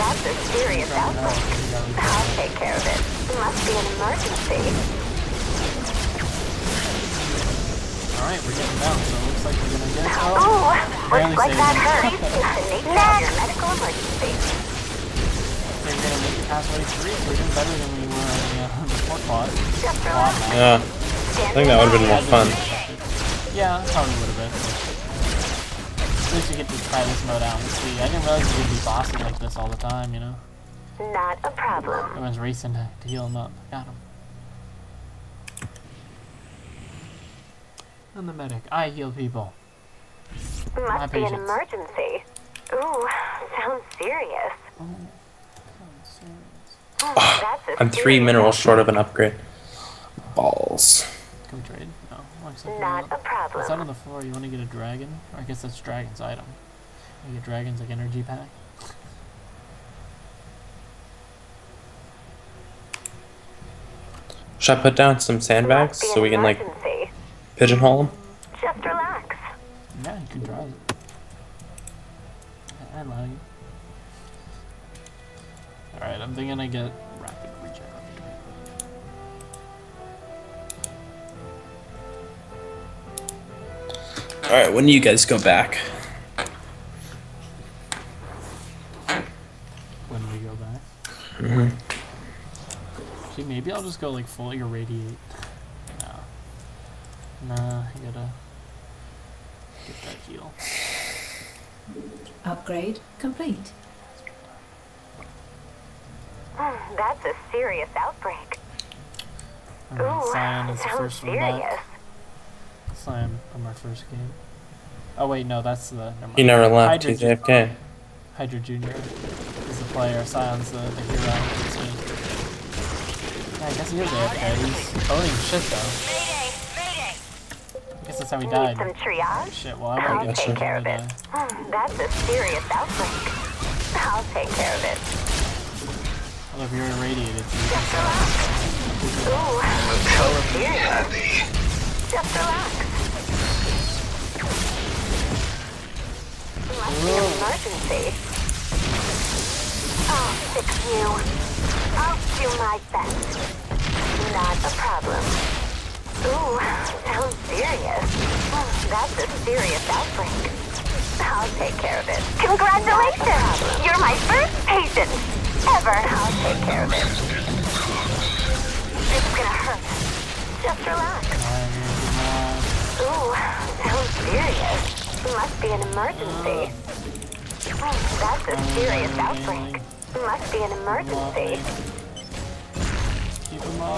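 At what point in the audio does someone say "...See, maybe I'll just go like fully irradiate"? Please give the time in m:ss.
1:33.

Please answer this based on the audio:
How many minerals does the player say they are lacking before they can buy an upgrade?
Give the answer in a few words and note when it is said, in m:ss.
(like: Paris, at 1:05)
3, at 0:47.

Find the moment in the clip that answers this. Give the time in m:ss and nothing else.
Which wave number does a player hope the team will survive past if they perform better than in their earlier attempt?
0:16.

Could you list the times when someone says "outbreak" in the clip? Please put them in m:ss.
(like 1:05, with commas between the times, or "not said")
0:00, 1:47, 2:12, 2:39, 2:59.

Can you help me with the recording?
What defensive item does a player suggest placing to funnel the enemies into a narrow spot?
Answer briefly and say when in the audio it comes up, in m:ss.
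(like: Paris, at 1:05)
Sandbags, at 1:05.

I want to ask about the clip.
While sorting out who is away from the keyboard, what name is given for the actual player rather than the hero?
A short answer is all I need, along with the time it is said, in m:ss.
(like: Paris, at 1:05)
Hydra Junior, at 1:58.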